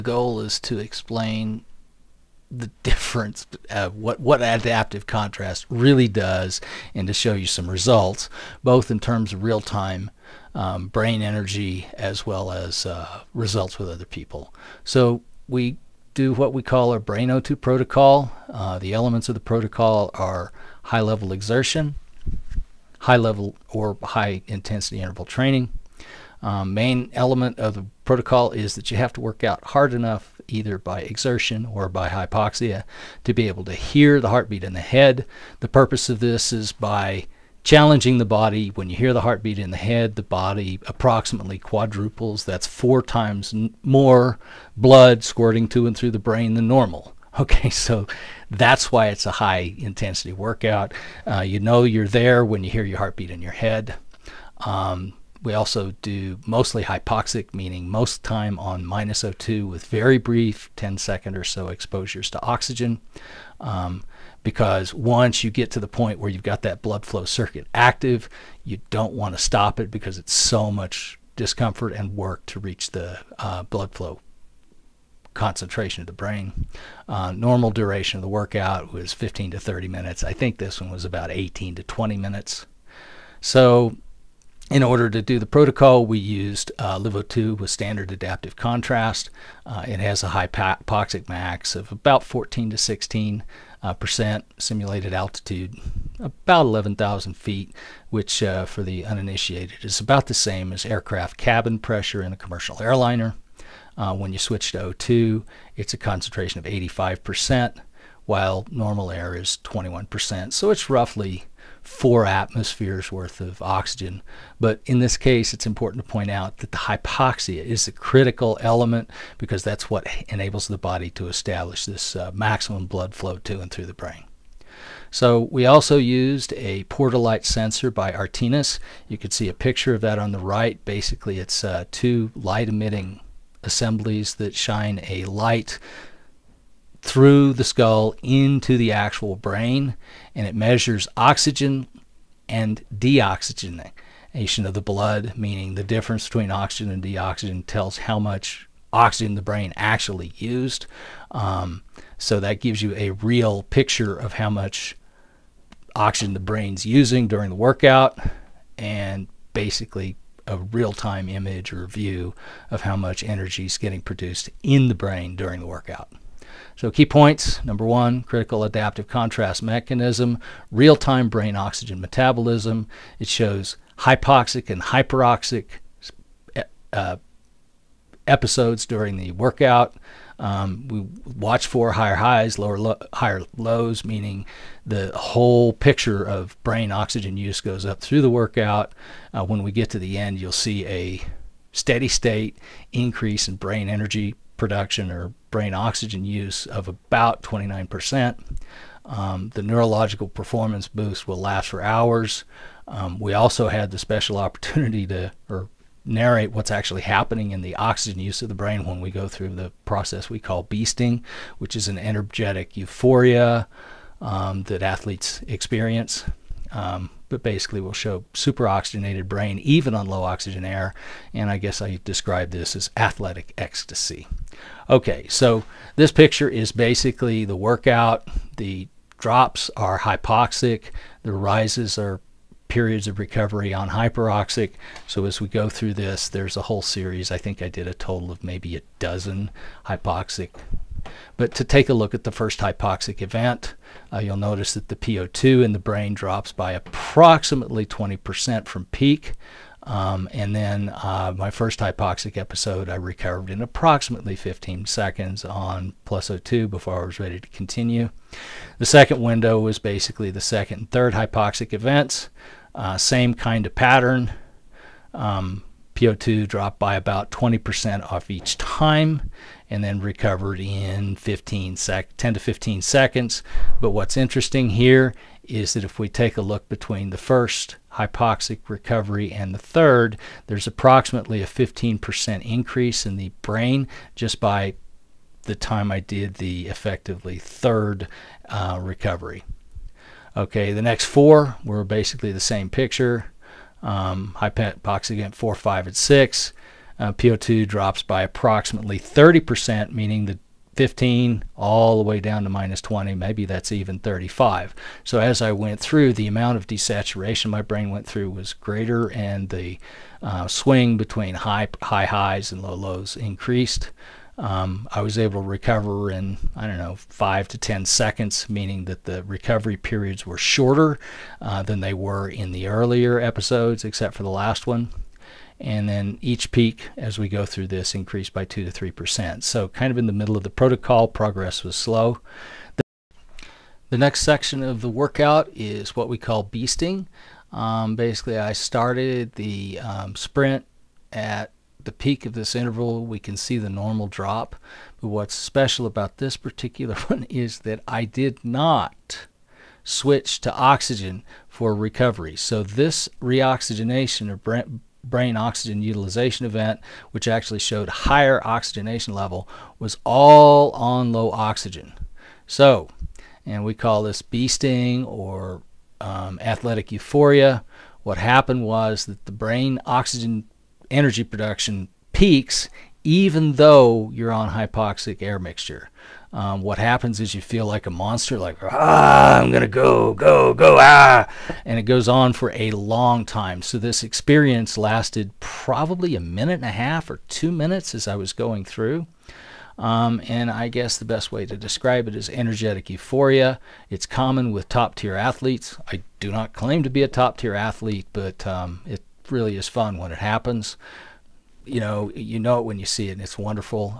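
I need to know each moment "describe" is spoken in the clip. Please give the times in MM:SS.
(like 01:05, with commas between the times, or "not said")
03:42, 06:31.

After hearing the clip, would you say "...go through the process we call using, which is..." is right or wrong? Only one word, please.
wrong.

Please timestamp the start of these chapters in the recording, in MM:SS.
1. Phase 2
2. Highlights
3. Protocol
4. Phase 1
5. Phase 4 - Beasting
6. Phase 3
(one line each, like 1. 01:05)
1. 04:17
2. 01:23
3. 00:09
4. 03:44
5. 05:31
6. 04:49.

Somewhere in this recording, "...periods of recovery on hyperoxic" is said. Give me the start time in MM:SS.
03:52.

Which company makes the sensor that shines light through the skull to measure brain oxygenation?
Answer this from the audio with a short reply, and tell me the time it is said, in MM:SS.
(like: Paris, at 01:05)
Artinis, at 02:08.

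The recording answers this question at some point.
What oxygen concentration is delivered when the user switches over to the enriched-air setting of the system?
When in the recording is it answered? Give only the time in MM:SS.
01:46.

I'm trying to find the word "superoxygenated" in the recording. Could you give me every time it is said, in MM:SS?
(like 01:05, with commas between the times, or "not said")
03:38.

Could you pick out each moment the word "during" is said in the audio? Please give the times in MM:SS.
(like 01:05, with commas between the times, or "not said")
02:37, 02:45, 02:58.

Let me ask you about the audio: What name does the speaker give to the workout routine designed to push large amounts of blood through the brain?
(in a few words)
Brain O2 protocol.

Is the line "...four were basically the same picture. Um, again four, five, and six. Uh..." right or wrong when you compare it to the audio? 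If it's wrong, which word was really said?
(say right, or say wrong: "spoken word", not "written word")
right.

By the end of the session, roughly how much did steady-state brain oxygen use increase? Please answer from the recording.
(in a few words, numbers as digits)
29%.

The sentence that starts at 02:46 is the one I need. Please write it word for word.
So, key points number one, critical adaptive contrast mechanism, real time brain oxygen metabolism.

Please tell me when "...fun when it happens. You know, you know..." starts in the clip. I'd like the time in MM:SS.
06:39.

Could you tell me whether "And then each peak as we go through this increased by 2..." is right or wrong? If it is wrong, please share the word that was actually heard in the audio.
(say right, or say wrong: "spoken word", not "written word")
right.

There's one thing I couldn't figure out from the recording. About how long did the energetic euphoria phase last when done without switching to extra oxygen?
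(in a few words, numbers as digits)
1.5 to 2 minutes.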